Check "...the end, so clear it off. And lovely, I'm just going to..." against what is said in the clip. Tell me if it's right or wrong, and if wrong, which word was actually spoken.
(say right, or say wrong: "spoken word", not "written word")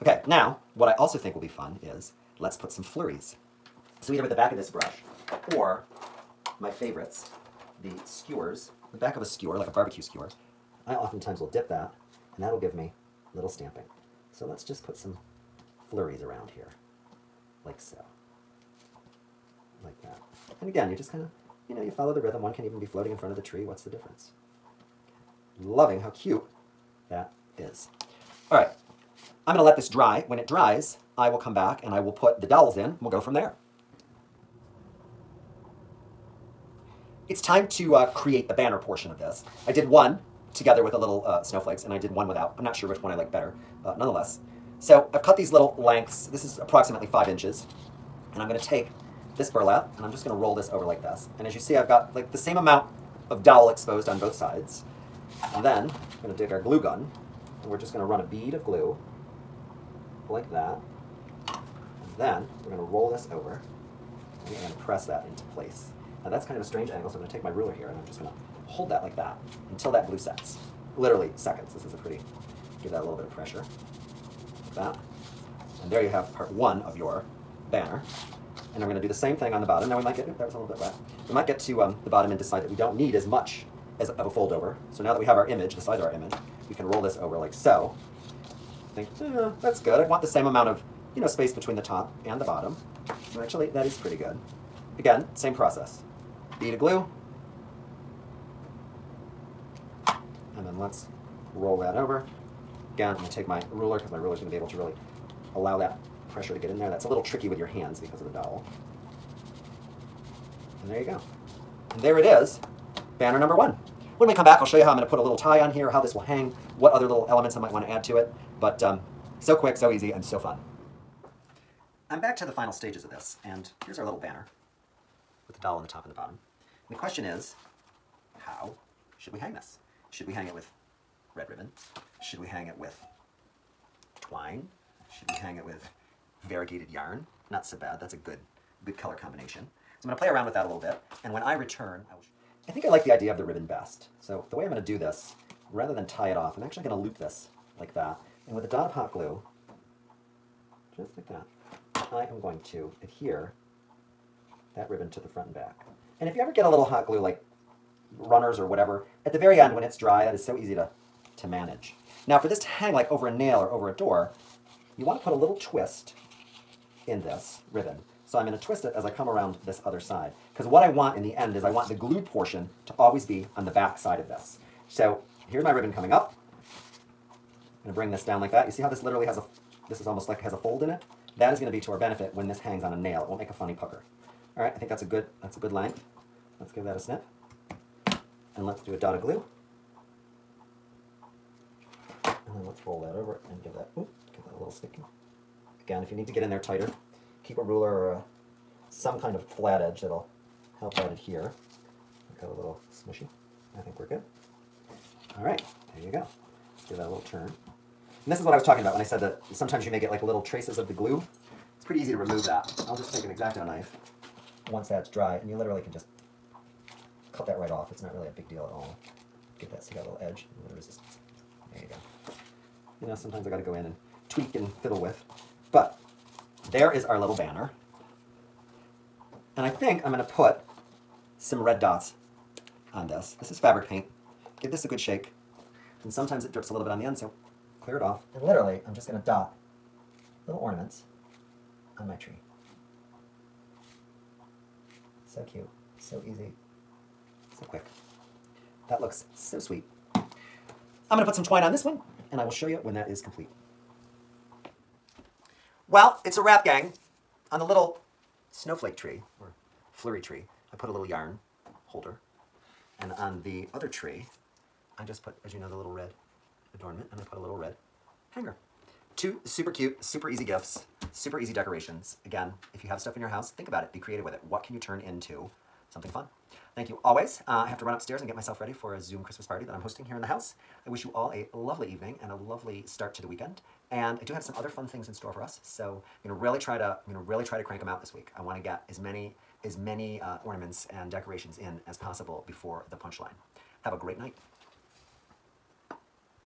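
wrong: "literally", not "lovely".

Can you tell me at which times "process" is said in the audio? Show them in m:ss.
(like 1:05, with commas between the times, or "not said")
1:35.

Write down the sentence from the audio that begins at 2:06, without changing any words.
And the question is, how should we hang this?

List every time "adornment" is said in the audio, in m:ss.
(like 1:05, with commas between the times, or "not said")
4:26.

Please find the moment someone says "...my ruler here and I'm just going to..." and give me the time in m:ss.
1:07.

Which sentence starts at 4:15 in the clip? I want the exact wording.
Well, it's a wrap, gang, on the little snowflake tree, or flurry tree.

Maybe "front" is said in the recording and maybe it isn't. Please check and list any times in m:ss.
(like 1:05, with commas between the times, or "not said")
0:23, 2:35.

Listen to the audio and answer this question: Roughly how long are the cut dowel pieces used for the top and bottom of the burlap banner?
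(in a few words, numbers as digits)
5 inches.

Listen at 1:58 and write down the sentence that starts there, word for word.
But um, so quick, so easy, and so fun.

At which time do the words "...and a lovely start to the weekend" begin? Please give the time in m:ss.
4:42.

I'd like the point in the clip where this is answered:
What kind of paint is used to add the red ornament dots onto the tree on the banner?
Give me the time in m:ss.
3:53.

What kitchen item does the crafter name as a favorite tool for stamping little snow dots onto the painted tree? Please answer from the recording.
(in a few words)
Skewers.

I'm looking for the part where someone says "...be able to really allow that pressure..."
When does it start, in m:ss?
1:44.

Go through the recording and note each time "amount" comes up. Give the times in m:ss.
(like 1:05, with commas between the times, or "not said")
0:52, 1:30.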